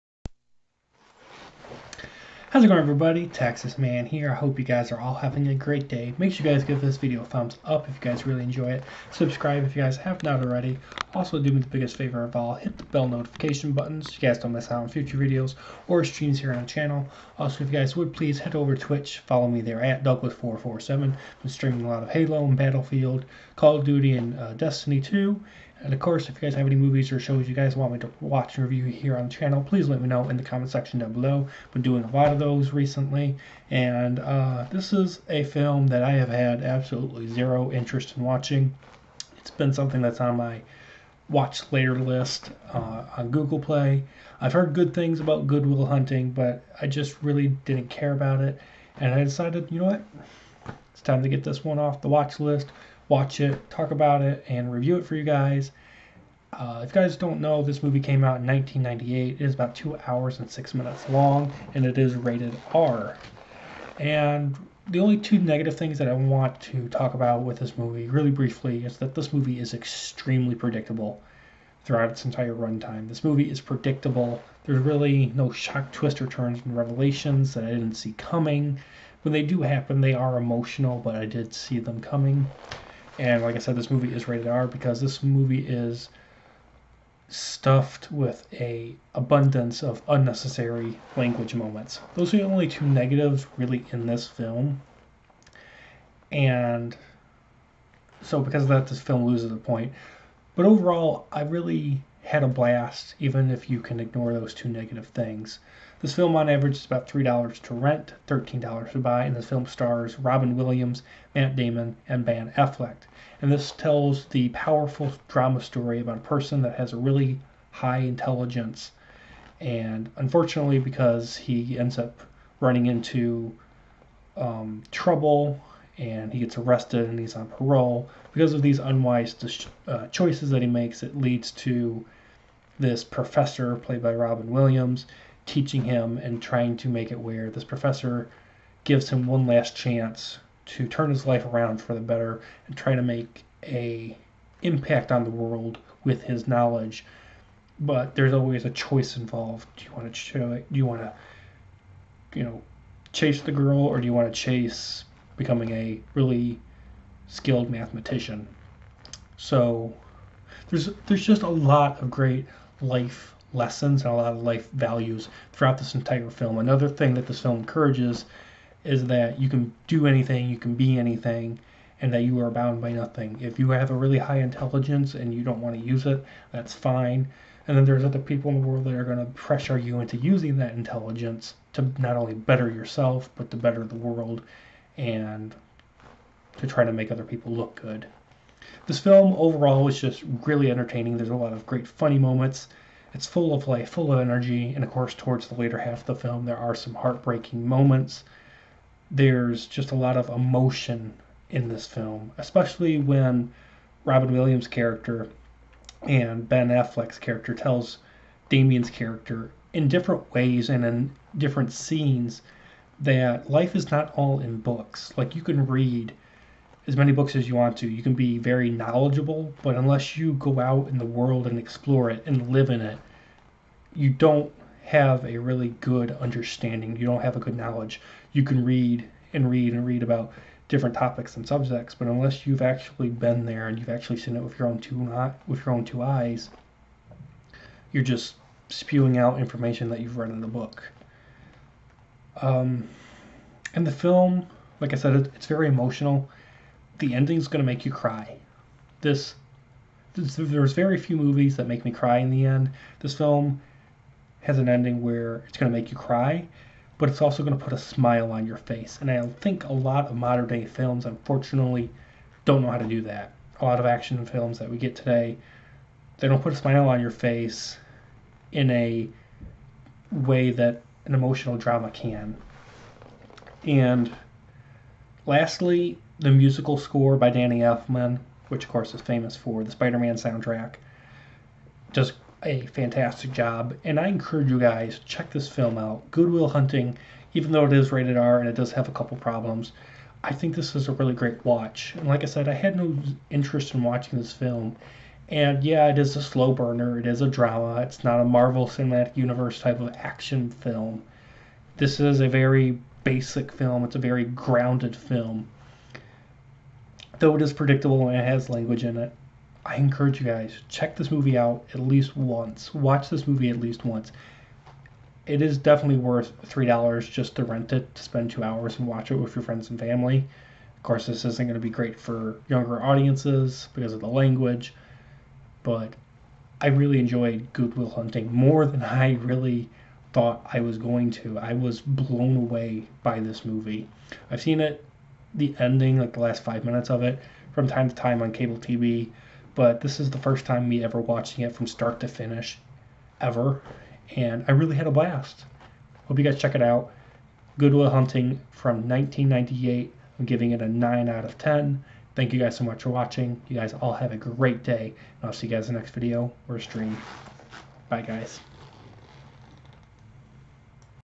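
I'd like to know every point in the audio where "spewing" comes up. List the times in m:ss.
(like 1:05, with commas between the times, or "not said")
3:58.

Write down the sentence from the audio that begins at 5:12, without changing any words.
Watch this movie at least once.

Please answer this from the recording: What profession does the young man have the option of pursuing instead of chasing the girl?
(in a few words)
mathematician.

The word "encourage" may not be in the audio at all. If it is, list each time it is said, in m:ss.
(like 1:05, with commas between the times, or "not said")
2:47, 4:44, 5:09.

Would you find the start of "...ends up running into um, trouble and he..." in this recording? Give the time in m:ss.
2:01.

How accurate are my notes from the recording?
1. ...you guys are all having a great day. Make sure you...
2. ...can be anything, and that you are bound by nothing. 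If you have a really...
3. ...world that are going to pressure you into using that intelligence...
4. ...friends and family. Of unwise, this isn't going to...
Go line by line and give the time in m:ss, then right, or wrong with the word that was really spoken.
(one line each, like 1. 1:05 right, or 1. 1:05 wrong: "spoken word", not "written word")
1. 0:04 right
2. 2:50 right
3. 2:58 right
4. 5:19 wrong: "course", not "unwise".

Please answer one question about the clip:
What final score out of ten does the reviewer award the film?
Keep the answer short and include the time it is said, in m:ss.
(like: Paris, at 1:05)
9, at 5:50.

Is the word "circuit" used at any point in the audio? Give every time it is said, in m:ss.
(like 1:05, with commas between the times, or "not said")
not said.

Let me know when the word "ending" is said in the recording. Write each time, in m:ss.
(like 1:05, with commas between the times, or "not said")
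4:07, 4:14, 5:35.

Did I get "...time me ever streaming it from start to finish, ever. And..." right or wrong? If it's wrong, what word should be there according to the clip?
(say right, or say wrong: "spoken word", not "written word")
wrong: "watching", not "streaming".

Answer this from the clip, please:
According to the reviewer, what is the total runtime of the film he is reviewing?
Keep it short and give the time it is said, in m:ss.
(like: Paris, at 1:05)
2 hours 6 minutes, at 0:59.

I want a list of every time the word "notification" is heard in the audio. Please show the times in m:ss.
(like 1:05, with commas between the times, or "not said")
0:13.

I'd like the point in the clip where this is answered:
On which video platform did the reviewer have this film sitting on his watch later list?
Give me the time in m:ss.
0:43.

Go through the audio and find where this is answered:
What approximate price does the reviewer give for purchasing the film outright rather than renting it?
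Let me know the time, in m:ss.
1:48.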